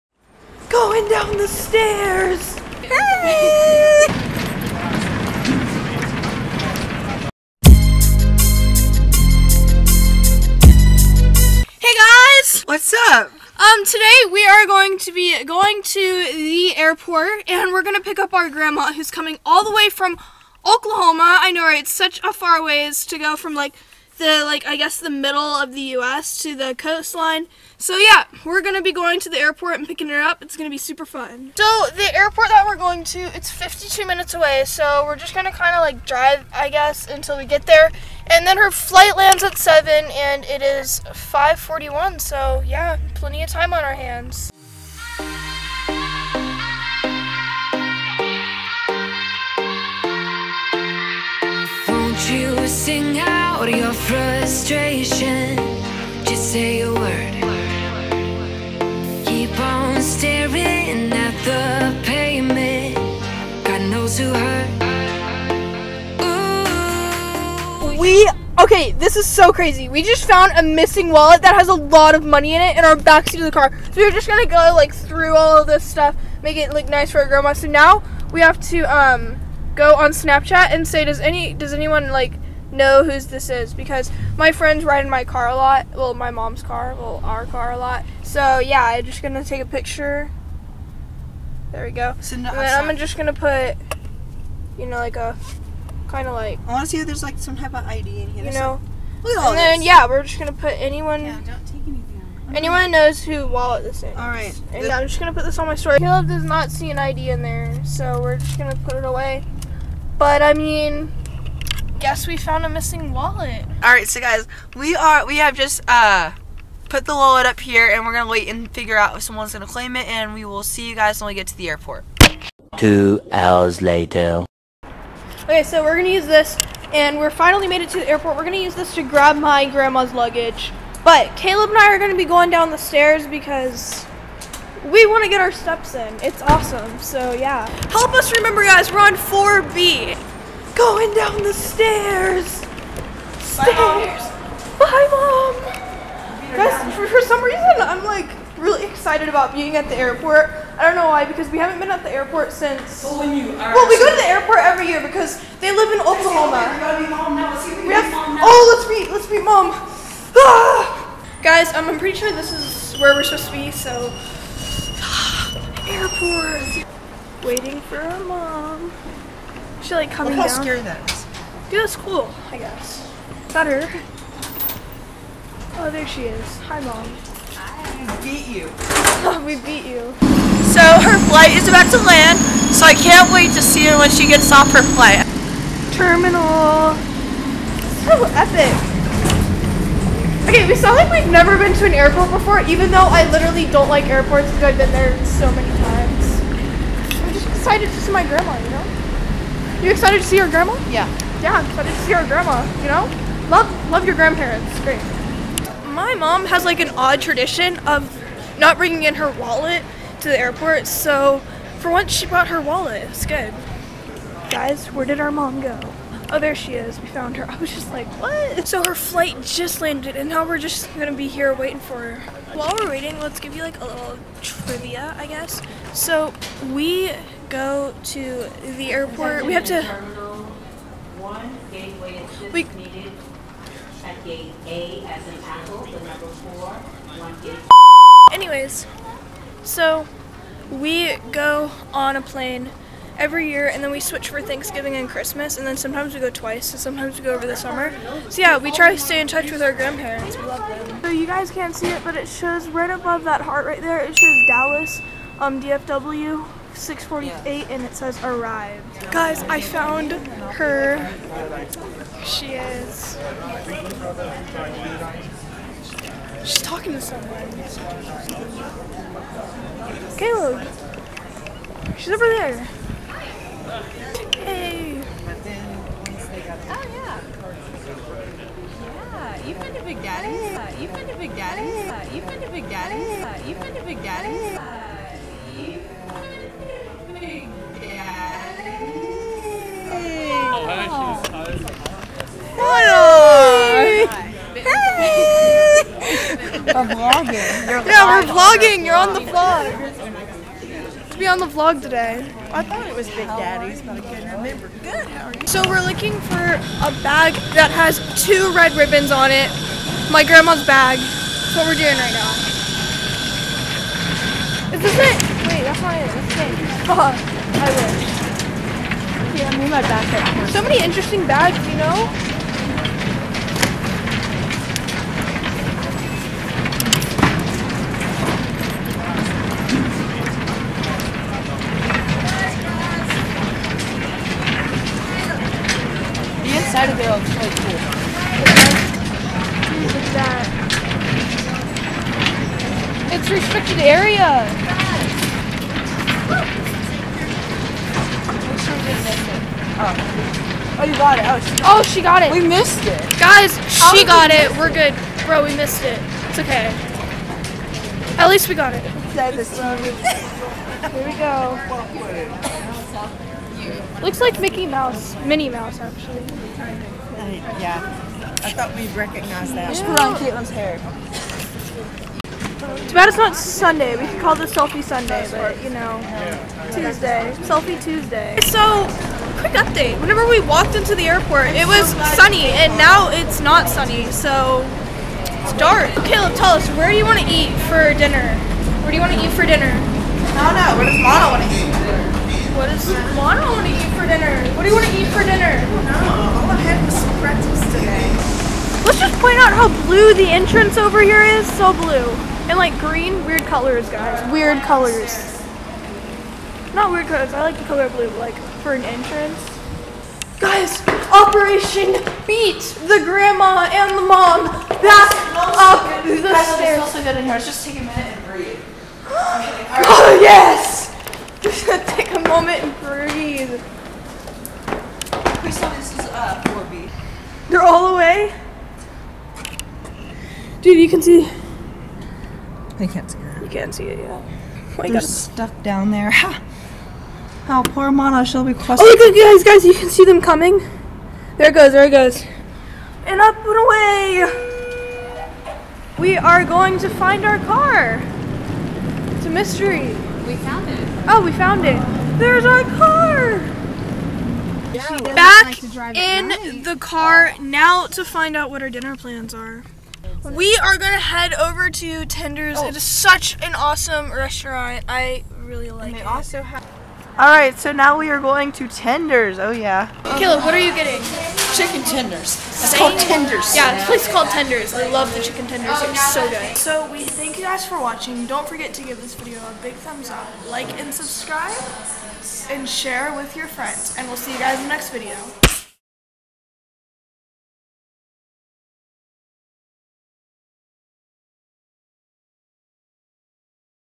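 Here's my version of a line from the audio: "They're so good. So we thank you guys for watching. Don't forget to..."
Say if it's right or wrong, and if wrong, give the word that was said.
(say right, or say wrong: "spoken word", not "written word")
right.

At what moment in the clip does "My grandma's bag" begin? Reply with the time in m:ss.
5:10.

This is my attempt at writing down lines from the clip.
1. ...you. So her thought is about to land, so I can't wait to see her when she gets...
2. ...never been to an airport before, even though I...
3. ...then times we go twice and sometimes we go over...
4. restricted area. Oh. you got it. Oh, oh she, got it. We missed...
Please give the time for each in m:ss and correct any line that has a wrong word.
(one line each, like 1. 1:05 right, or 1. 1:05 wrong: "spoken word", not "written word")
1. 2:59 wrong: "flight", not "thought"
2. 3:11 right
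3. 4:05 wrong: "sometimes", not "times"
4. 5:43 right.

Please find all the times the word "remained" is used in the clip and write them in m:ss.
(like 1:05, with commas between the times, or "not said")
not said.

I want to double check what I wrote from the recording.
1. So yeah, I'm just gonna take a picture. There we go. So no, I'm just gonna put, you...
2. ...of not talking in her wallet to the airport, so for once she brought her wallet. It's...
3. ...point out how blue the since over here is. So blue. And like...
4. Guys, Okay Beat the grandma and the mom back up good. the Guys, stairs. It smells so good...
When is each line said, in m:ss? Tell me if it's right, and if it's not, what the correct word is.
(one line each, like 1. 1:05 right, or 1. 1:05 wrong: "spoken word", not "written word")
1. 1:28 right
2. 3:27 wrong: "bringing", not "talking"
3. 6:39 wrong: "entrance", not "since"
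4. 6:50 wrong: "Operation", not "Okay".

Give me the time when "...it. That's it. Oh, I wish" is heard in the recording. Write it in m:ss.
5:15.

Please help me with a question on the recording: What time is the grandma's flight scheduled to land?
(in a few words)
7.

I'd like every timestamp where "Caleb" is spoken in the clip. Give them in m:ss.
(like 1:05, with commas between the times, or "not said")
1:45, 2:11, 4:30, 6:26, 7:50.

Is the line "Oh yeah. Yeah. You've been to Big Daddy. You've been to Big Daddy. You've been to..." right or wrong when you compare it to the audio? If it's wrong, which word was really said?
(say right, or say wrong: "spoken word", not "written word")
right.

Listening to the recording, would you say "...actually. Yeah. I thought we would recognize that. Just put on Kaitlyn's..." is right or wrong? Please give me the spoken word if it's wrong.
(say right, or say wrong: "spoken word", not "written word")
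right.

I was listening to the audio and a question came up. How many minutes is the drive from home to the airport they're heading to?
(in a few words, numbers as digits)
52.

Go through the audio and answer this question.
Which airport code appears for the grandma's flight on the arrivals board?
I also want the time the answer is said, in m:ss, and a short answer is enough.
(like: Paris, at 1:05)
DFW, at 4:15.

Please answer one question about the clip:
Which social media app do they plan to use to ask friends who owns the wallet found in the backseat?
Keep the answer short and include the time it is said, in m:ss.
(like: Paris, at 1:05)
Snapchat, at 1:20.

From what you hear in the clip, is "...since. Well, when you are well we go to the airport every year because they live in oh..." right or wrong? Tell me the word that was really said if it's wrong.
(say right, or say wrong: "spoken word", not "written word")
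right.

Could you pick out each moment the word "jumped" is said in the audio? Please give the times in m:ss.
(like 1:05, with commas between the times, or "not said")
not said.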